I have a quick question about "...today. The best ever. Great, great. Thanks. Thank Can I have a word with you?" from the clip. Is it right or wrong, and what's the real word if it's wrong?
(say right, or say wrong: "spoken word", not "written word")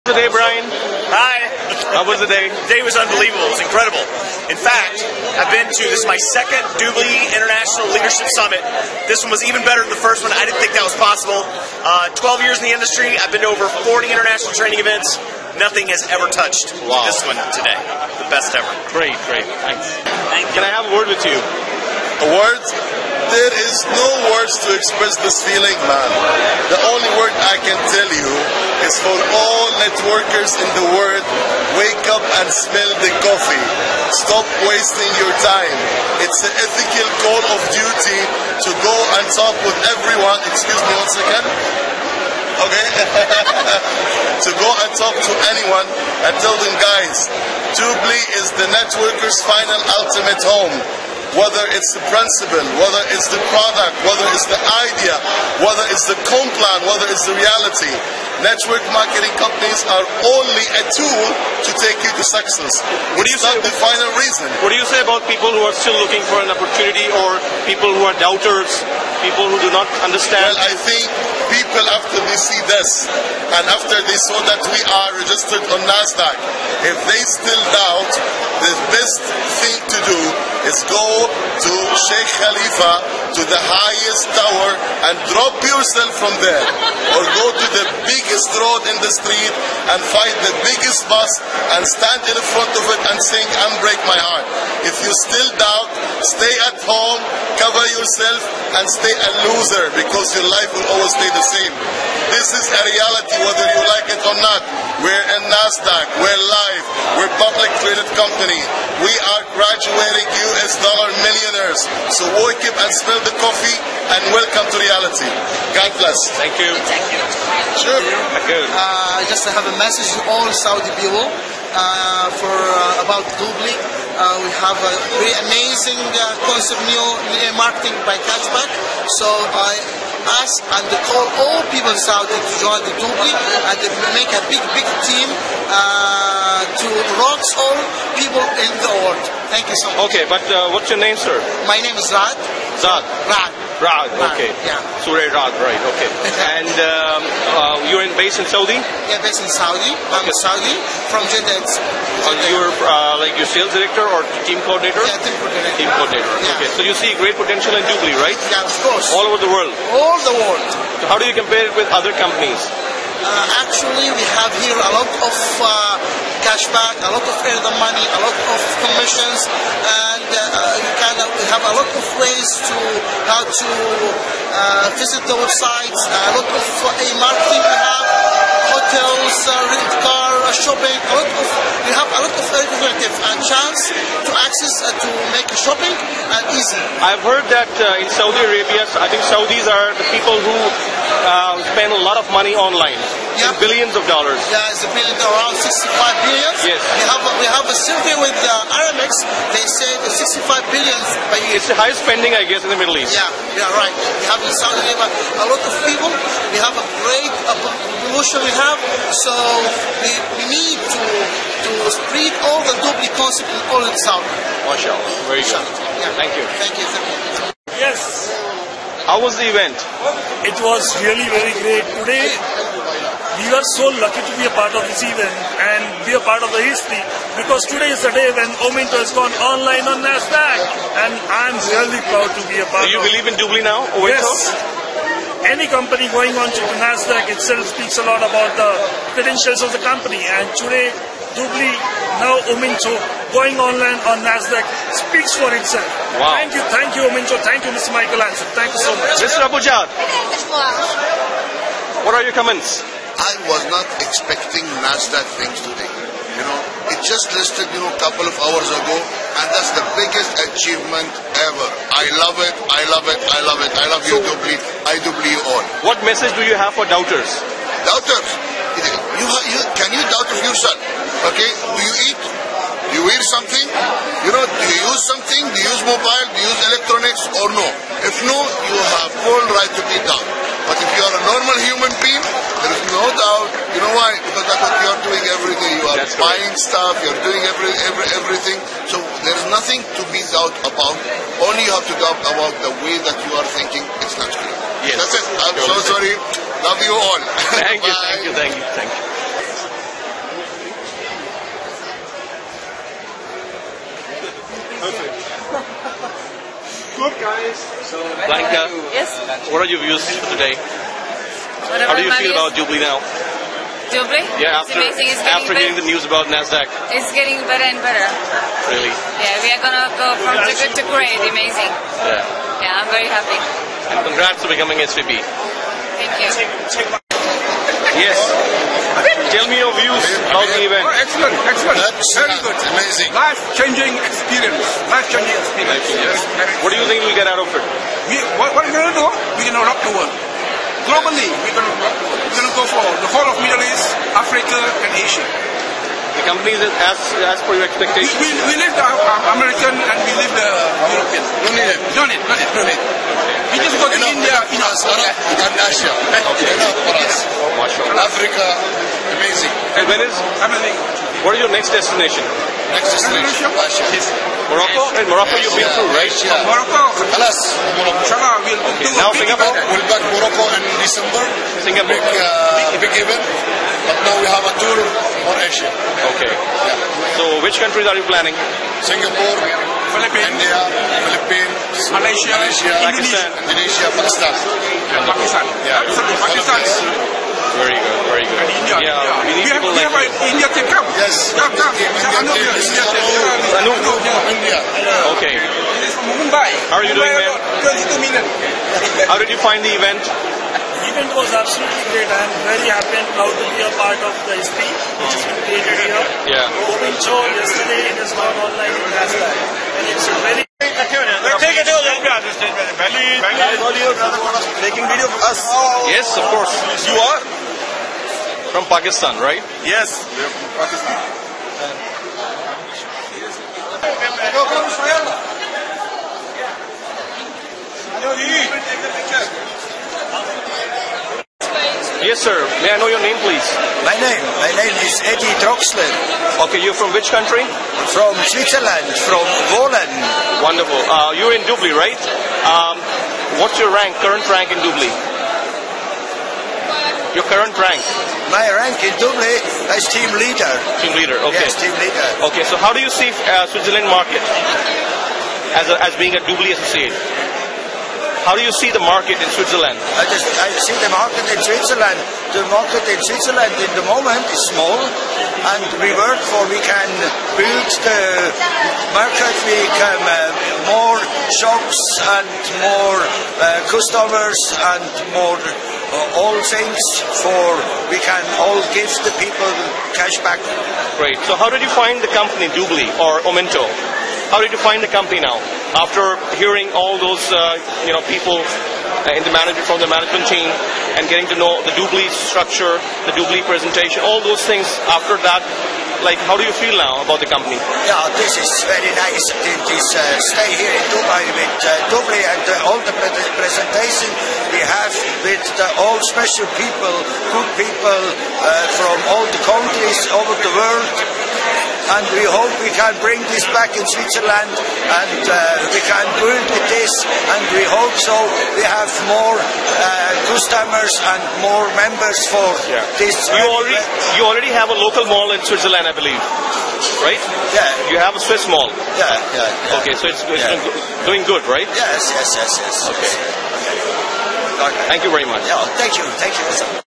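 right.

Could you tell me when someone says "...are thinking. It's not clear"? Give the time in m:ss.
4:53.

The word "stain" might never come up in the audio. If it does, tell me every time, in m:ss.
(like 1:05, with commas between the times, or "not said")
not said.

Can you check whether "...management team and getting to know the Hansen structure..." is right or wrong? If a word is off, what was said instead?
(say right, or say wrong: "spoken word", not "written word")
wrong: "Dubli", not "Hansen".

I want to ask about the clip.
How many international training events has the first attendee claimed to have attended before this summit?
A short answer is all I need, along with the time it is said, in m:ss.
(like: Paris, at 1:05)
over 40, at 0:13.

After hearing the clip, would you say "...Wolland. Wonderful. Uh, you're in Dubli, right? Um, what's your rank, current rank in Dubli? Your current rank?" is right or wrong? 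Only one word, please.
right.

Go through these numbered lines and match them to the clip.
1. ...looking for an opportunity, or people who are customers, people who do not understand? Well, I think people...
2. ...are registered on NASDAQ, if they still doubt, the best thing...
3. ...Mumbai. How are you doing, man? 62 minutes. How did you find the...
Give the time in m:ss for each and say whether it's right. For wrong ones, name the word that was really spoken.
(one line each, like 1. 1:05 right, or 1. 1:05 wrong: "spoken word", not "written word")
1. 1:06 wrong: "doubters", not "customers"
2. 1:14 right
3. 6:36 wrong: "22", not "62".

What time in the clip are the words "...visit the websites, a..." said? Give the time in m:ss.
2:54.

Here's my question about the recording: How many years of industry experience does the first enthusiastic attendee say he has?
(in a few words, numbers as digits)
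12.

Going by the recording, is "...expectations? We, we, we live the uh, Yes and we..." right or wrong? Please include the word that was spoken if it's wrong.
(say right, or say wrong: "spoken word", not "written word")
wrong: "American", not "Yes".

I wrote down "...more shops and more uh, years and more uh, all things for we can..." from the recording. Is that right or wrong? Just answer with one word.
wrong.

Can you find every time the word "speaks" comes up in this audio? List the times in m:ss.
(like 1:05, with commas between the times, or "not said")
3:57, 4:05.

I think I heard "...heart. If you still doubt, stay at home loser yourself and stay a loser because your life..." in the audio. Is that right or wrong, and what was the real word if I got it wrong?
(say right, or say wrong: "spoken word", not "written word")
wrong: "cover", not "loser".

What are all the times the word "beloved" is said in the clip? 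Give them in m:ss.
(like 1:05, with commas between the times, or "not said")
not said.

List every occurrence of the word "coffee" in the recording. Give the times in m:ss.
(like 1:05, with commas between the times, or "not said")
0:33, 1:53.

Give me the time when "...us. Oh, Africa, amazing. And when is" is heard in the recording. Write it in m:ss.
5:57.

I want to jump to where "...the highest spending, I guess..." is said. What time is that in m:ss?
3:21.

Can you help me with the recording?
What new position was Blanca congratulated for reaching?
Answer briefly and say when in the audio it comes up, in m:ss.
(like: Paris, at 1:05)
SVP, at 5:24.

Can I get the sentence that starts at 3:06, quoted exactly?
I've heard that in Saudi Arabia, I think Saudis are the people who spend a lot of money online yep.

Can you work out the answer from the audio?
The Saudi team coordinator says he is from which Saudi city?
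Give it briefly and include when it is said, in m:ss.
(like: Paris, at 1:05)
Jeddah, at 2:31.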